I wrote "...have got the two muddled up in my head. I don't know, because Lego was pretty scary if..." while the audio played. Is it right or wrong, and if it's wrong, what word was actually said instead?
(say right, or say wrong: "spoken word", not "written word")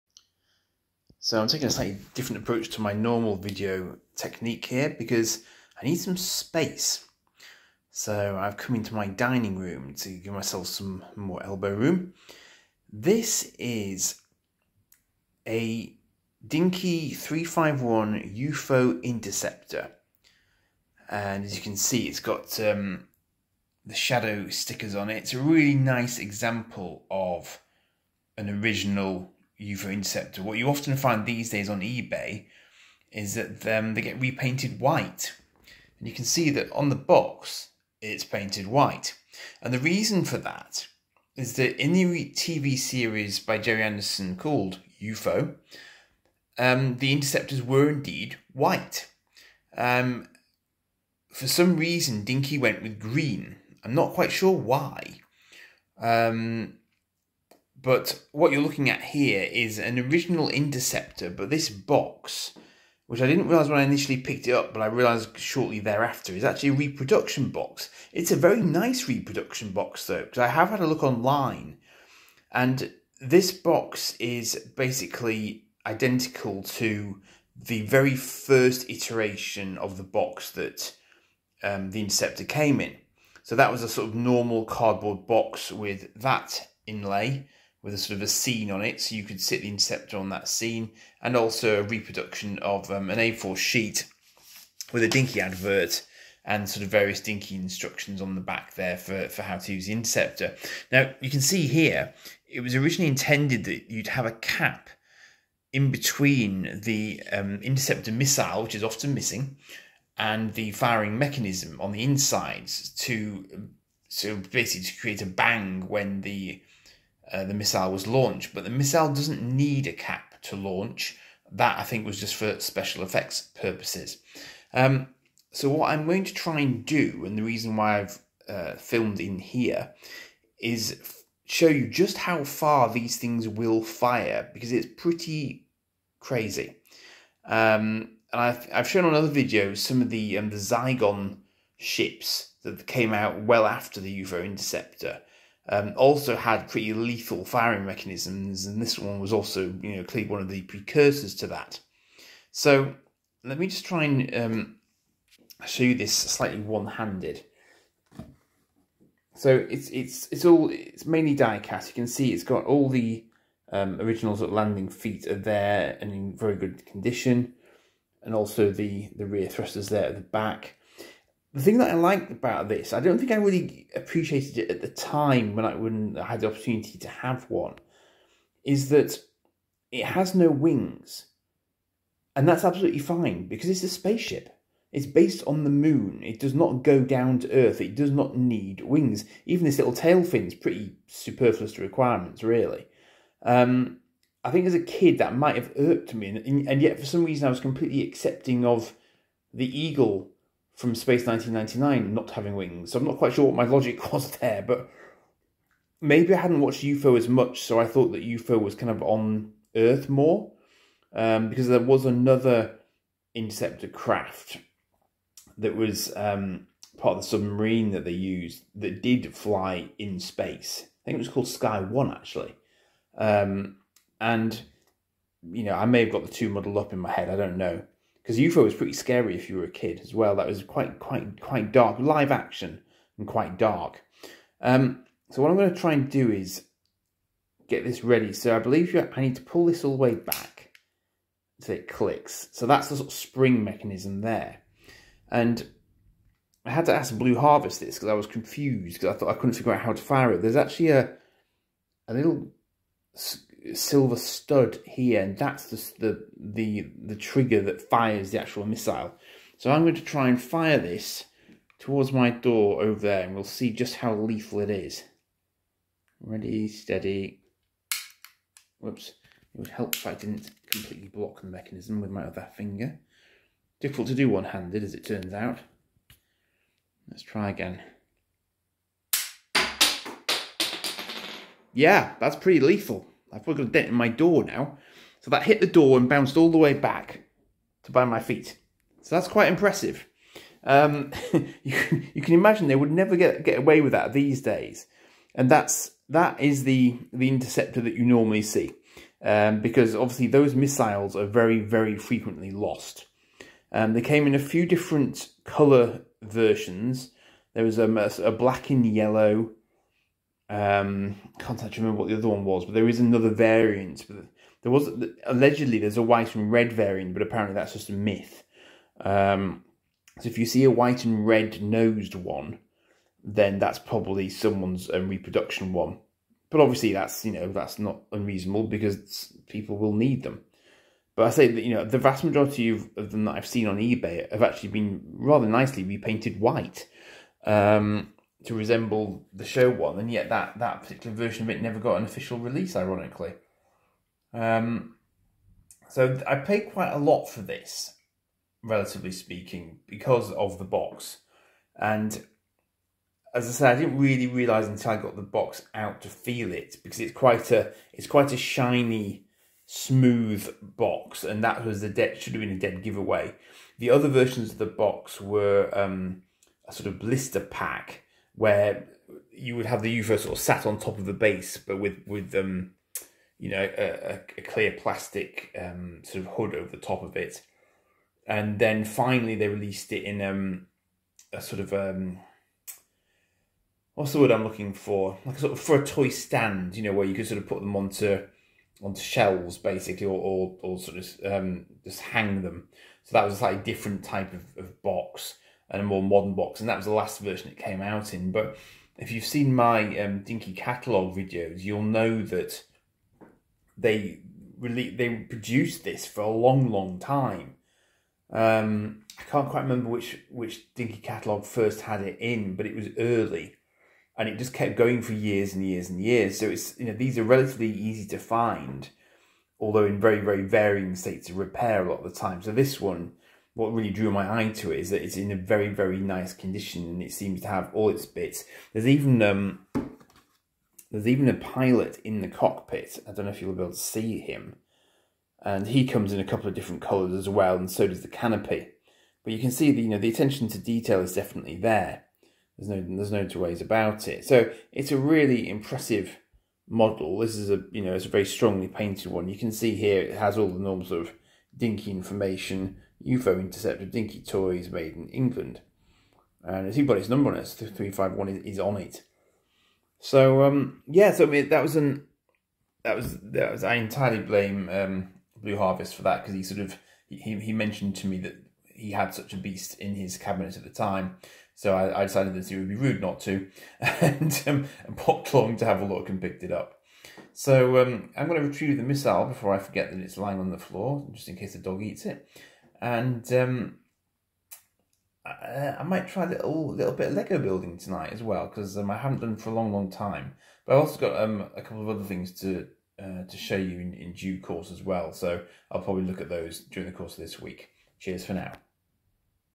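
wrong: "UFO", not "Lego".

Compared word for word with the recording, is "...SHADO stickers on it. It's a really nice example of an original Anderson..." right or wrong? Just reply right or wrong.
wrong.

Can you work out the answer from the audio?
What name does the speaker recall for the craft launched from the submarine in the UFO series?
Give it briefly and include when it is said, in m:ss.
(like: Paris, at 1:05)
Sky One, at 3:41.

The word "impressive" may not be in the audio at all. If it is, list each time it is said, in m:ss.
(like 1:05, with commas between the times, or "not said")
4:49, 7:25.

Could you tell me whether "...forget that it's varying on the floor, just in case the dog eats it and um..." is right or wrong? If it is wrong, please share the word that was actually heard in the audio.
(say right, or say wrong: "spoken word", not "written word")
wrong: "lying", not "varying".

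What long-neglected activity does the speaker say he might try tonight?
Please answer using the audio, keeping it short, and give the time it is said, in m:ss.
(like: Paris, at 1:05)
Lego building, at 8:07.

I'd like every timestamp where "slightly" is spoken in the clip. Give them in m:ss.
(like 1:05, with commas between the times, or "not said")
0:01, 2:36, 6:33.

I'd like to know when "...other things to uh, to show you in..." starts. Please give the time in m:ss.
8:11.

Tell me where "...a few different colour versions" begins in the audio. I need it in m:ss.
5:04.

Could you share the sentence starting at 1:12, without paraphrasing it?
And this box is basically identical to the very first iteration of the box that um, the Interceptor came in.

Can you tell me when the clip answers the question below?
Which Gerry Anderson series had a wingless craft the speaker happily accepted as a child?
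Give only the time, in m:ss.
3:20.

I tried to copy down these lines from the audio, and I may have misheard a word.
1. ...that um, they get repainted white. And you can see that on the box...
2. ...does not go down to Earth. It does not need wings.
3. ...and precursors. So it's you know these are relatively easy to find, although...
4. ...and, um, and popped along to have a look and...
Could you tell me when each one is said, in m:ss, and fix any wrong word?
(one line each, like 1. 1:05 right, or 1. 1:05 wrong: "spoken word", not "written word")
1. 0:33 right
2. 3:06 right
3. 6:55 wrong: "years", not "precursors"
4. 7:53 right.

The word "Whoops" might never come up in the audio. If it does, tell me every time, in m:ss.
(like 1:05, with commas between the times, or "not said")
4:28.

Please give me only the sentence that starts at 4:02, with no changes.
So that's the sort of spring mechanism there.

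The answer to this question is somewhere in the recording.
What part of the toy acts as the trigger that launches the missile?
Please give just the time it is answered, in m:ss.
4:12.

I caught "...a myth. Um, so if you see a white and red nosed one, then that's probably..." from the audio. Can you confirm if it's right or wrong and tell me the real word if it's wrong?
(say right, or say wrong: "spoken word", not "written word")
right.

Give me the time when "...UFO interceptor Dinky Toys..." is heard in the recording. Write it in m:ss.
7:33.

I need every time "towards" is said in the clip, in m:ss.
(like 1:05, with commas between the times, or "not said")
4:21.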